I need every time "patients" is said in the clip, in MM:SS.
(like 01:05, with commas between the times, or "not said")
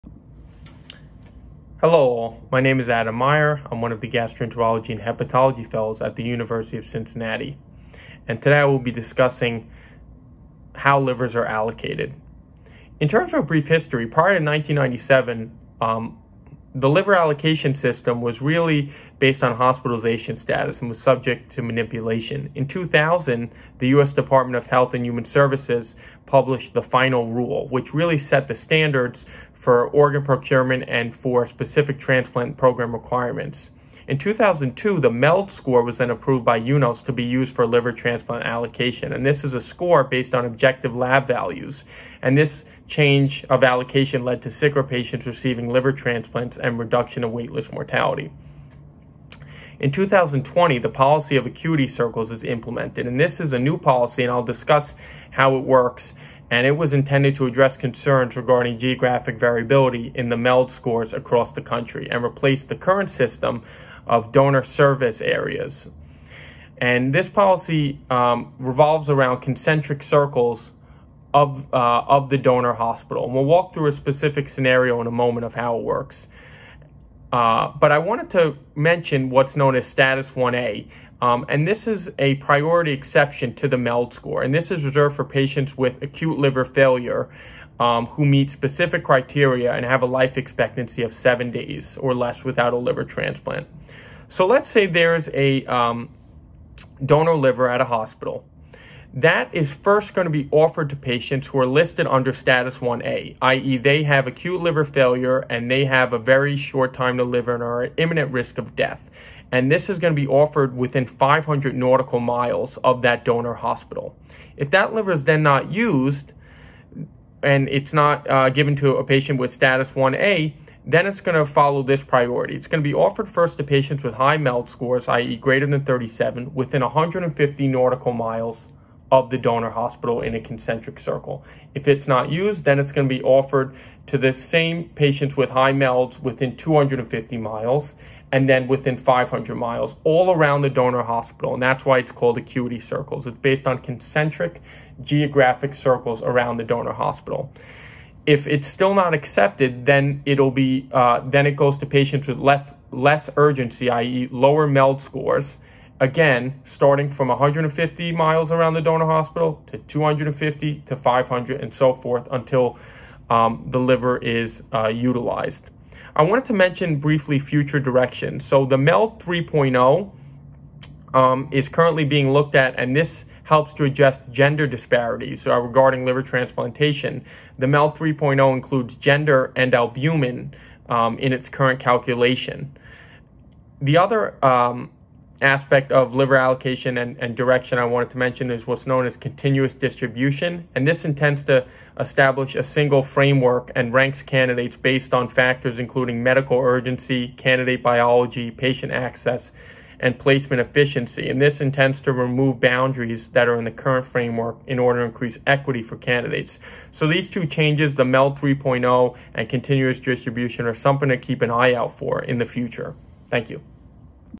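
00:44, 01:25, 01:40, 01:59, 02:03, 02:14, 02:31, 03:18.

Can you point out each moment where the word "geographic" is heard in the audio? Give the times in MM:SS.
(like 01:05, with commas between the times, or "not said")
00:58, 02:25.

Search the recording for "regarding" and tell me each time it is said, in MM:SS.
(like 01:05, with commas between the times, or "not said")
00:58, 02:55.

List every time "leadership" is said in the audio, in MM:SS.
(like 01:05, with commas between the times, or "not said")
not said.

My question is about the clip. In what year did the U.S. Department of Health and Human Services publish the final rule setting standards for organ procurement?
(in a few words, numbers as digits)
2000.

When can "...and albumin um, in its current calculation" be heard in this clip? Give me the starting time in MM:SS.
02:59.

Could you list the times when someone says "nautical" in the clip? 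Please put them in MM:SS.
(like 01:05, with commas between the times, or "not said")
01:51, 02:07.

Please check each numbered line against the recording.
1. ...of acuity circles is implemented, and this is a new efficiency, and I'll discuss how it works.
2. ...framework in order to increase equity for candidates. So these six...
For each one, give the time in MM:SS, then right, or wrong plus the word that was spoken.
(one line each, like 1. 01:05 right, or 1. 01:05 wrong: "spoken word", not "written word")
1. 00:51 wrong: "policy", not "efficiency"
2. 03:24 wrong: "two", not "six".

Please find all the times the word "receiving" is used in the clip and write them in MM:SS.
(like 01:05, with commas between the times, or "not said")
00:45.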